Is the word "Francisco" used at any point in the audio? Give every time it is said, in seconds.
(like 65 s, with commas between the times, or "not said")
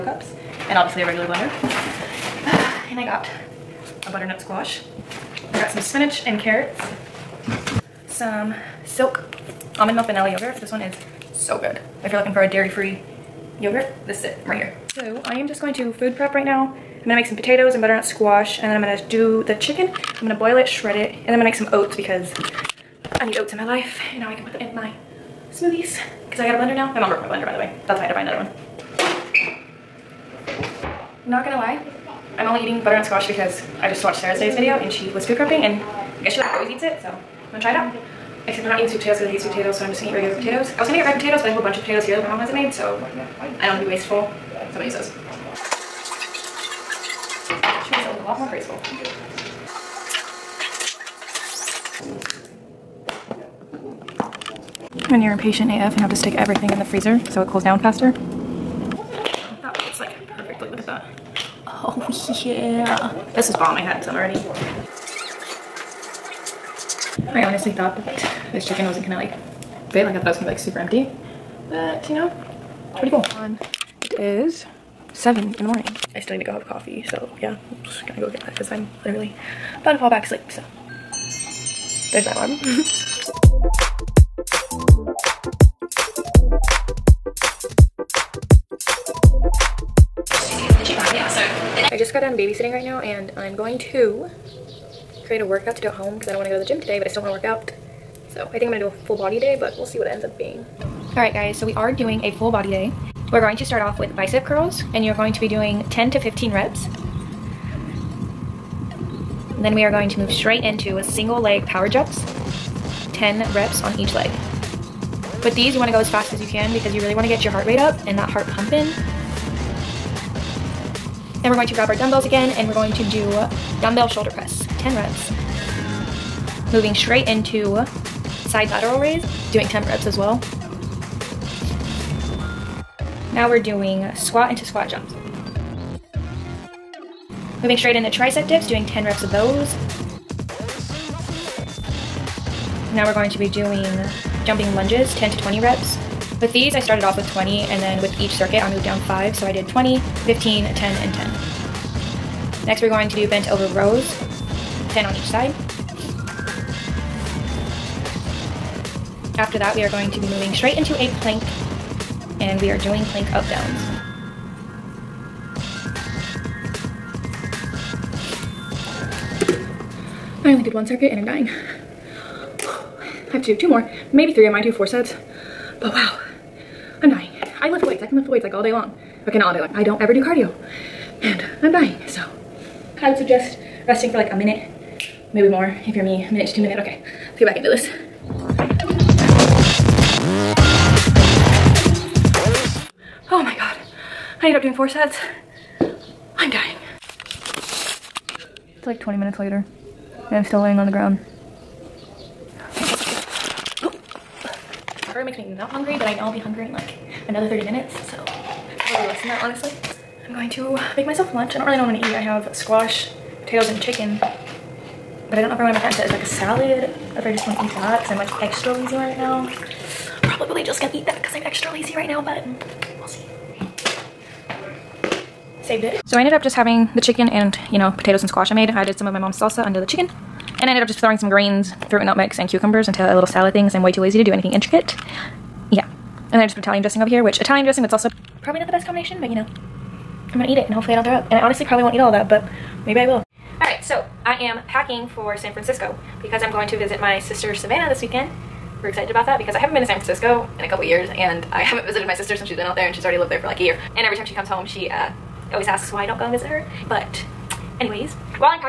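245 s, 249 s.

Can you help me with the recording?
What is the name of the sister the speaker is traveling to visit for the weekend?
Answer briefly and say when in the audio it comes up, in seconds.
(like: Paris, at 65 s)
Savannah, at 247 s.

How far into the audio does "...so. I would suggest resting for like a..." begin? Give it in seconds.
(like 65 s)
182 s.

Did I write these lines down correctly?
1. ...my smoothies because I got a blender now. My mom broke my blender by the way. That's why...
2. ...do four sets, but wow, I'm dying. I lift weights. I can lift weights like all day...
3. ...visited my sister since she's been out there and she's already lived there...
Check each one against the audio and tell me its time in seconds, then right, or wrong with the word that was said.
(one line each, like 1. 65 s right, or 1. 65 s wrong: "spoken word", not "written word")
1. 24 s right
2. 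174 s right
3. 251 s right.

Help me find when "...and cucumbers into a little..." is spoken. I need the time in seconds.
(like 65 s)
232 s.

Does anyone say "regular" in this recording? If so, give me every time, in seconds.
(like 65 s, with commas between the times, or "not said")
1 s, 40 s.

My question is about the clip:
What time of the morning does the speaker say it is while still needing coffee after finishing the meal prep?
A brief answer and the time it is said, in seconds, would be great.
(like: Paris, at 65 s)
7, at 75 s.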